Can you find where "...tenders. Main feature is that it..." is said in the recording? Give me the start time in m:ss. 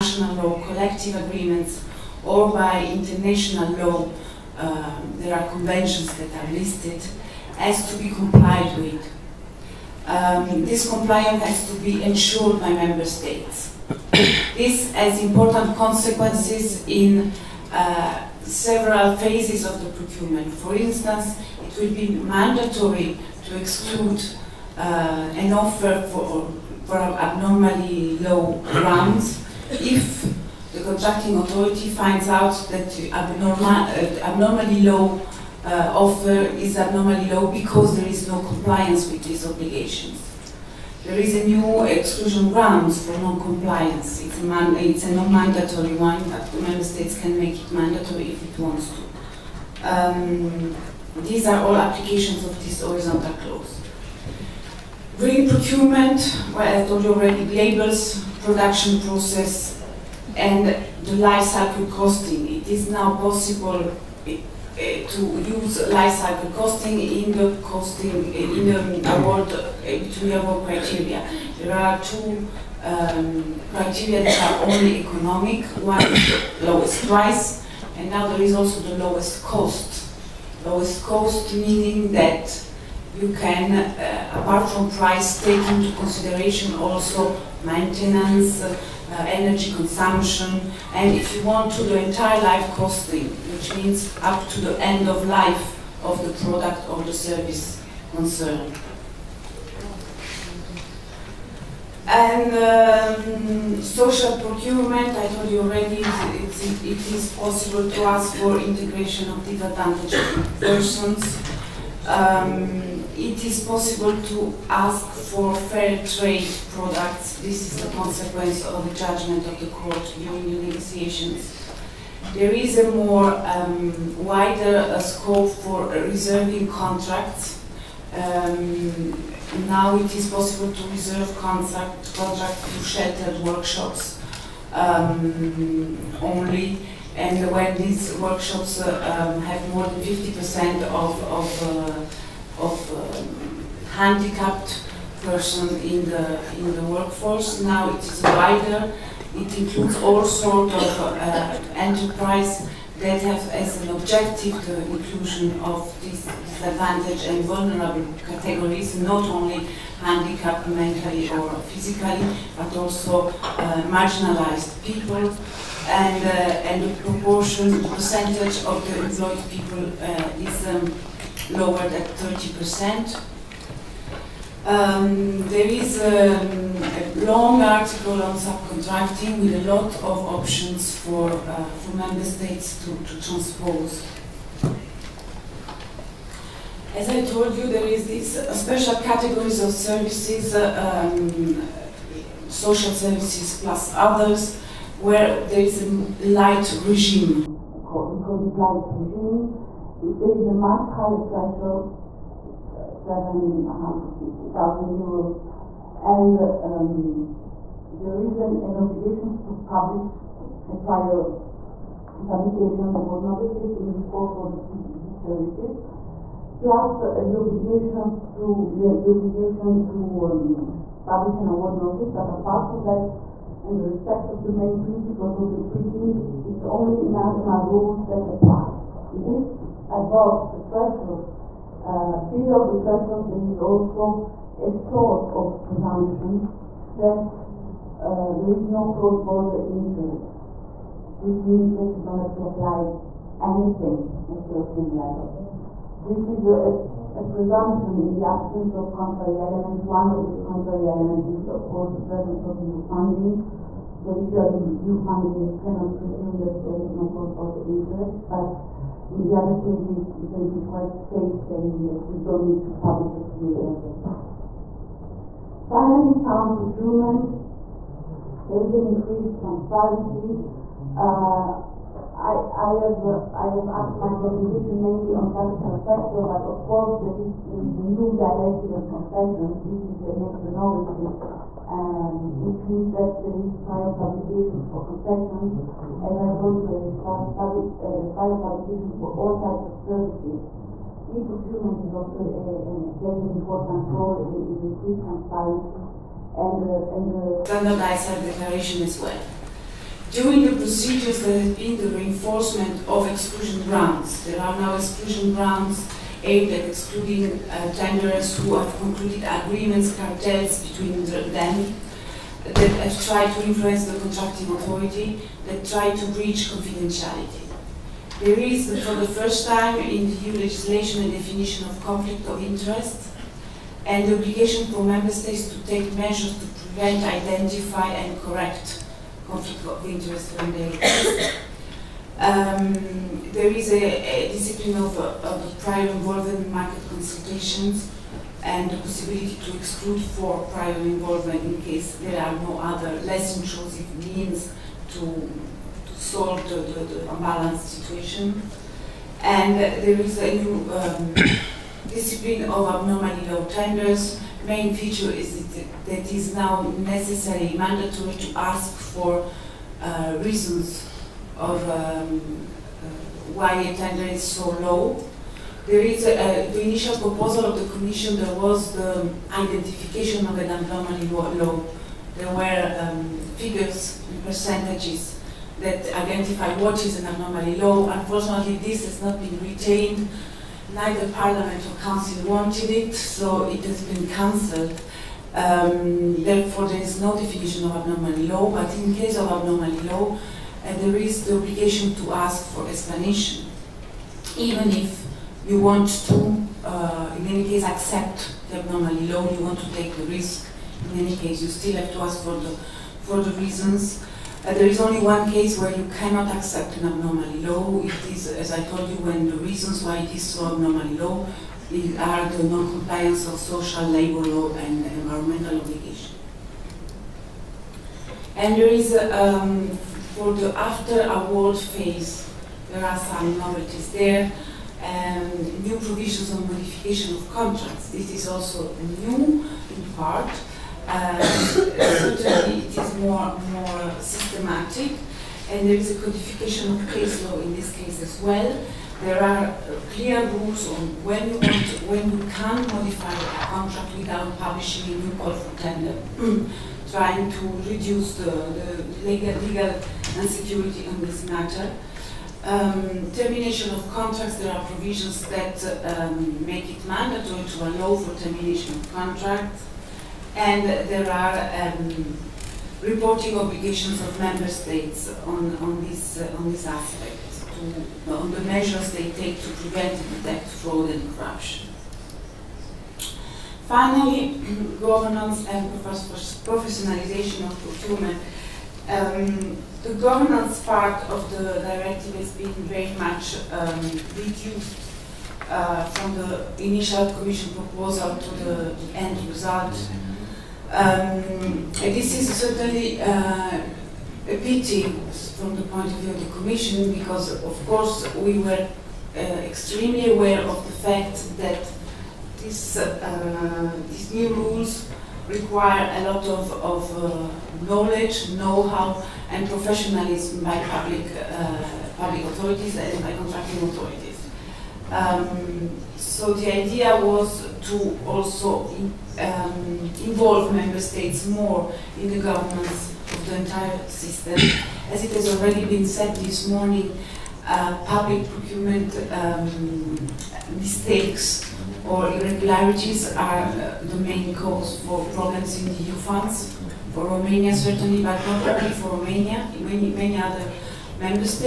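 5:53.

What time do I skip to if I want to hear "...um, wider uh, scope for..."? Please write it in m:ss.
2:03.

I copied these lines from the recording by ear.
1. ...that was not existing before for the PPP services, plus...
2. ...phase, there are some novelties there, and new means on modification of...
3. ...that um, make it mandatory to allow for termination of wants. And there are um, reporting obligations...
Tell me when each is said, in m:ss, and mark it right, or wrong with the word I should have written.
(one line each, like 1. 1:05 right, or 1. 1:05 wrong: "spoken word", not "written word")
1. 3:32 right
2. 7:01 wrong: "provisions", not "means"
3. 7:35 wrong: "contracts", not "wants".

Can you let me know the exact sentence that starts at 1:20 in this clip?
Lowest cost meaning that you can, uh, apart from price, take into consideration also maintenance.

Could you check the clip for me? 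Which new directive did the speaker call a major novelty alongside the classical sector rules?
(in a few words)
Directive on concessions.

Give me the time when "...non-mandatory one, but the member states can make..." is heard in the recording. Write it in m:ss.
0:45.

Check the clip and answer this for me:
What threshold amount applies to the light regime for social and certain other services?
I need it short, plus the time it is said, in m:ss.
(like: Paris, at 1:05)
750,000 euros, at 3:23.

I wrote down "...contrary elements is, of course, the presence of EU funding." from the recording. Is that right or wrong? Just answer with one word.
right.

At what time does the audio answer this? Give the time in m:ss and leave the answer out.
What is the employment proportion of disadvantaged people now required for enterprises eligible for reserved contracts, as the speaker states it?
2:52.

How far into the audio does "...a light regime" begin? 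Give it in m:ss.
3:15.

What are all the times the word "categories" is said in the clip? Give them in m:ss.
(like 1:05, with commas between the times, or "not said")
2:38, 3:09.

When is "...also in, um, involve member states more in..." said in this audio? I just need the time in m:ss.
8:38.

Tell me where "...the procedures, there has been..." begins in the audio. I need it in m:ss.
5:00.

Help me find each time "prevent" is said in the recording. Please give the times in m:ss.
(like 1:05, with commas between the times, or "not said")
5:26, 7:49.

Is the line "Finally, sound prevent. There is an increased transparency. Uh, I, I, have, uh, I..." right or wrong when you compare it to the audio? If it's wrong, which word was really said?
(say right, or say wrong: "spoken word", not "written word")
wrong: "procurement", not "prevent".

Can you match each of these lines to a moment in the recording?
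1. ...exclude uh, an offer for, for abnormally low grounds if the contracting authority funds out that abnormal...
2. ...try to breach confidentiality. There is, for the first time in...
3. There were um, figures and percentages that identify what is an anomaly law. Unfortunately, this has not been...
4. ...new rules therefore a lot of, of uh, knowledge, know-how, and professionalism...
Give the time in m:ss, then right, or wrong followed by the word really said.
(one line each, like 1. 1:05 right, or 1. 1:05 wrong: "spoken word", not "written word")
1. 0:23 wrong: "finds", not "funds"
2. 5:15 right
3. 6:12 right
4. 8:24 wrong: "require", not "therefore".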